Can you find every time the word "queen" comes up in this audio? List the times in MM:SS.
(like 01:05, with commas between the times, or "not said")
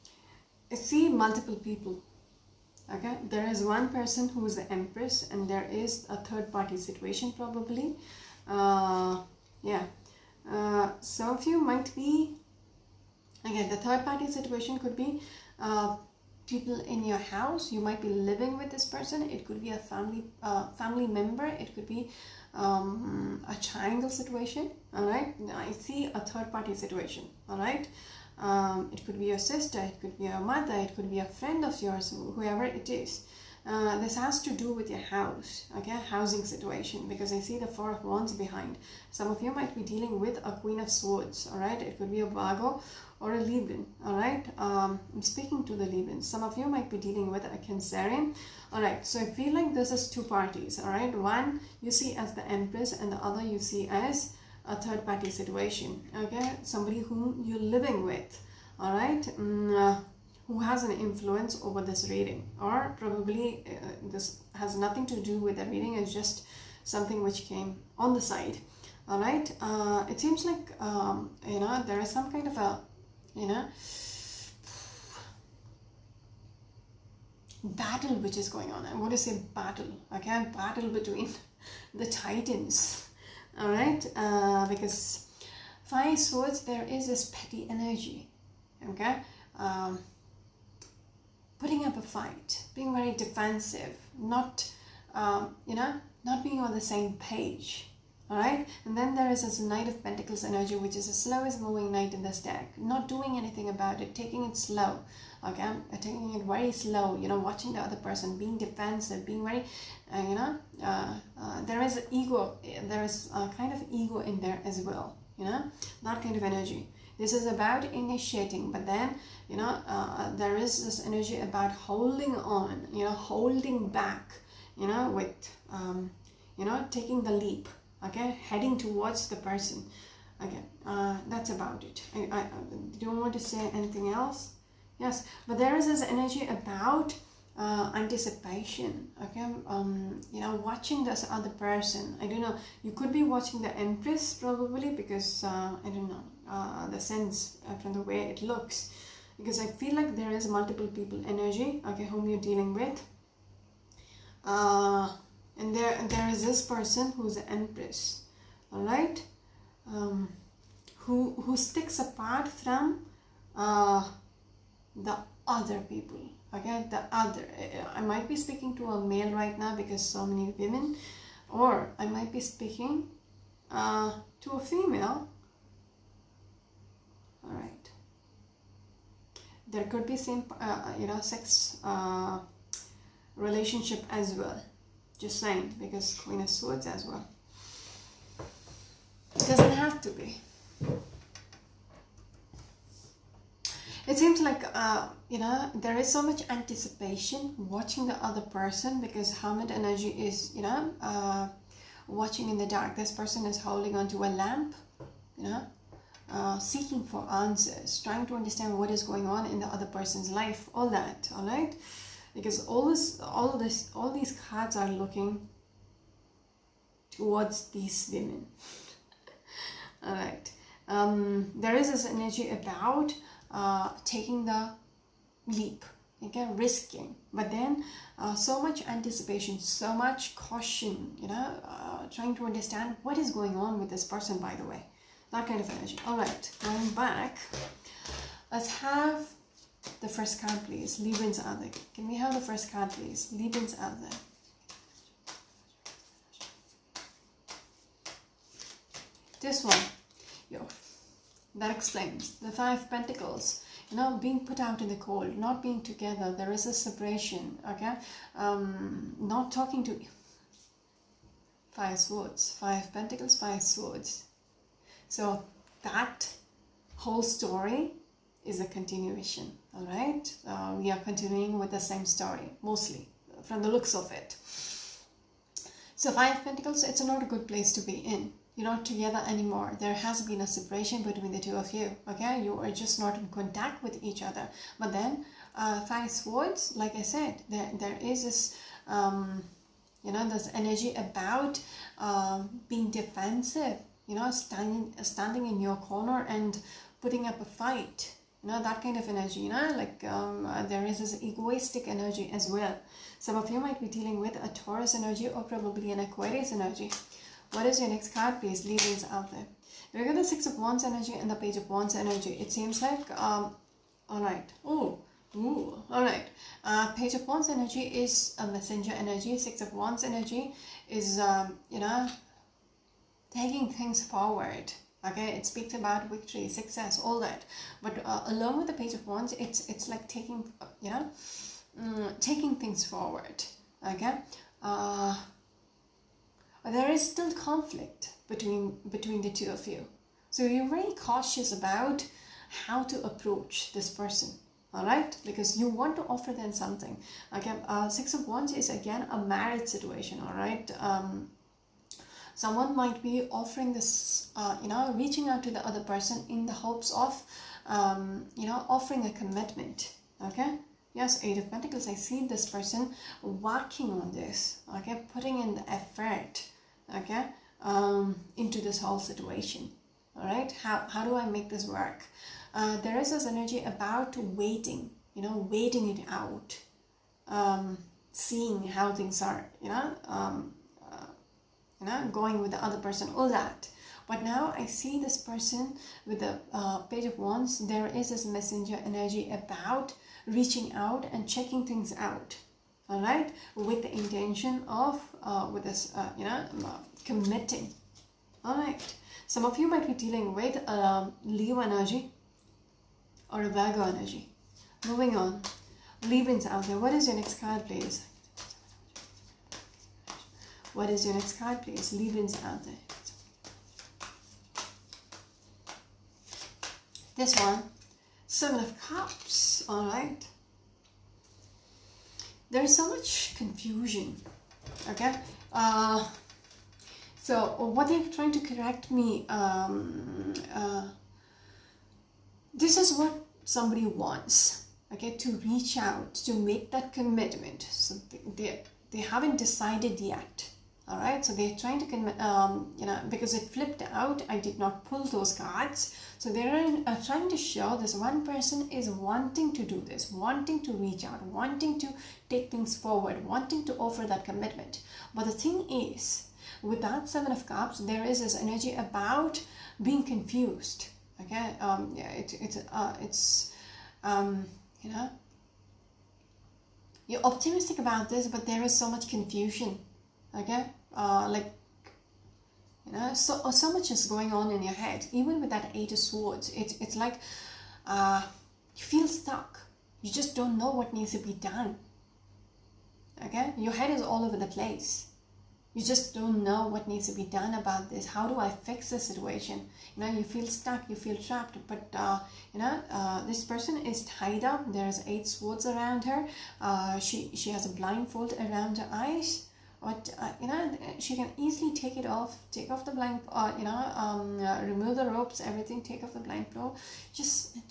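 00:40, 03:06.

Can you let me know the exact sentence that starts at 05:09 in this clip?
We got the Six of Wands energy and the Page of Wands energy.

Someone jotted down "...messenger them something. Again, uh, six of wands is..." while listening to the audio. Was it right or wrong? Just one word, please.
wrong.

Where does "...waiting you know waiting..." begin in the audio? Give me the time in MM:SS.
06:14.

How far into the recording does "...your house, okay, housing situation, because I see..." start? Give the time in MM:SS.
00:34.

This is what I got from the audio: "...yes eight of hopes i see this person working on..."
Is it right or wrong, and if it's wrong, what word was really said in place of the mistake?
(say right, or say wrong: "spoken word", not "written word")
wrong: "pentacles", not "hopes".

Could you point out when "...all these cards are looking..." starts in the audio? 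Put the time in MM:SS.
03:33.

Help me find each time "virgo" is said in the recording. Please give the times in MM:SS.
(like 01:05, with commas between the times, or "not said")
00:42, 06:43.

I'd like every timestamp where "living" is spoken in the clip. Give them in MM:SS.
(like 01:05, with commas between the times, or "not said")
00:18, 00:57.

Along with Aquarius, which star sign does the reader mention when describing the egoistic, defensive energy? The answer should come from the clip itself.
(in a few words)
Taurus.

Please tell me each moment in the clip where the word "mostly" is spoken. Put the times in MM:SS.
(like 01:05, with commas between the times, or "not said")
04:32.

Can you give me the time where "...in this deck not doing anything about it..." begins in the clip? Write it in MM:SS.
01:42.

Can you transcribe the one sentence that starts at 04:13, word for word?
You know, being put out in the cold, not being together.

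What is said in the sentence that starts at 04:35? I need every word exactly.
So five pentacles, it's not a good place to be in you're not together anymore.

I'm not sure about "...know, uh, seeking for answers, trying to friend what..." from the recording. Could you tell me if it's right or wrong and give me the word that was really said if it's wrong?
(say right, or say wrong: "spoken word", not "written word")
wrong: "understand", not "friend".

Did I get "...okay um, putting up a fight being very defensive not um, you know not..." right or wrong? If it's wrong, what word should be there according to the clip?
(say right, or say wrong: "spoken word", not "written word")
right.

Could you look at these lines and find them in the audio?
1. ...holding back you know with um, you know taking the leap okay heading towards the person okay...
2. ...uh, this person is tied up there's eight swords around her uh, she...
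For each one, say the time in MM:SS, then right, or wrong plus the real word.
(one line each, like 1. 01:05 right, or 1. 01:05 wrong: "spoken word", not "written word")
1. 02:03 right
2. 08:12 right.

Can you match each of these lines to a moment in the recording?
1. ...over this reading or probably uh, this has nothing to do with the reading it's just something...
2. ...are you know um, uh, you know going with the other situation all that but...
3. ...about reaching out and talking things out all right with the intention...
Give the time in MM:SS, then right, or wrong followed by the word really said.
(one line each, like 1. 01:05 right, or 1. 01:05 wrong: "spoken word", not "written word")
1. 01:01 right
2. 06:19 wrong: "person", not "situation"
3. 06:29 wrong: "checking", not "talking".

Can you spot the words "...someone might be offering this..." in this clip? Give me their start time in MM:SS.
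05:52.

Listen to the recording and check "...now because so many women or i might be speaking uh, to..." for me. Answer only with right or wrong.
right.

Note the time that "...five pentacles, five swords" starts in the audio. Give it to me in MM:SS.
04:22.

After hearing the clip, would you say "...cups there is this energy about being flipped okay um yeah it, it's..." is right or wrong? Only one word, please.
wrong.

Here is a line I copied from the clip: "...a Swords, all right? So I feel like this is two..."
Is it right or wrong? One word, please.
wrong.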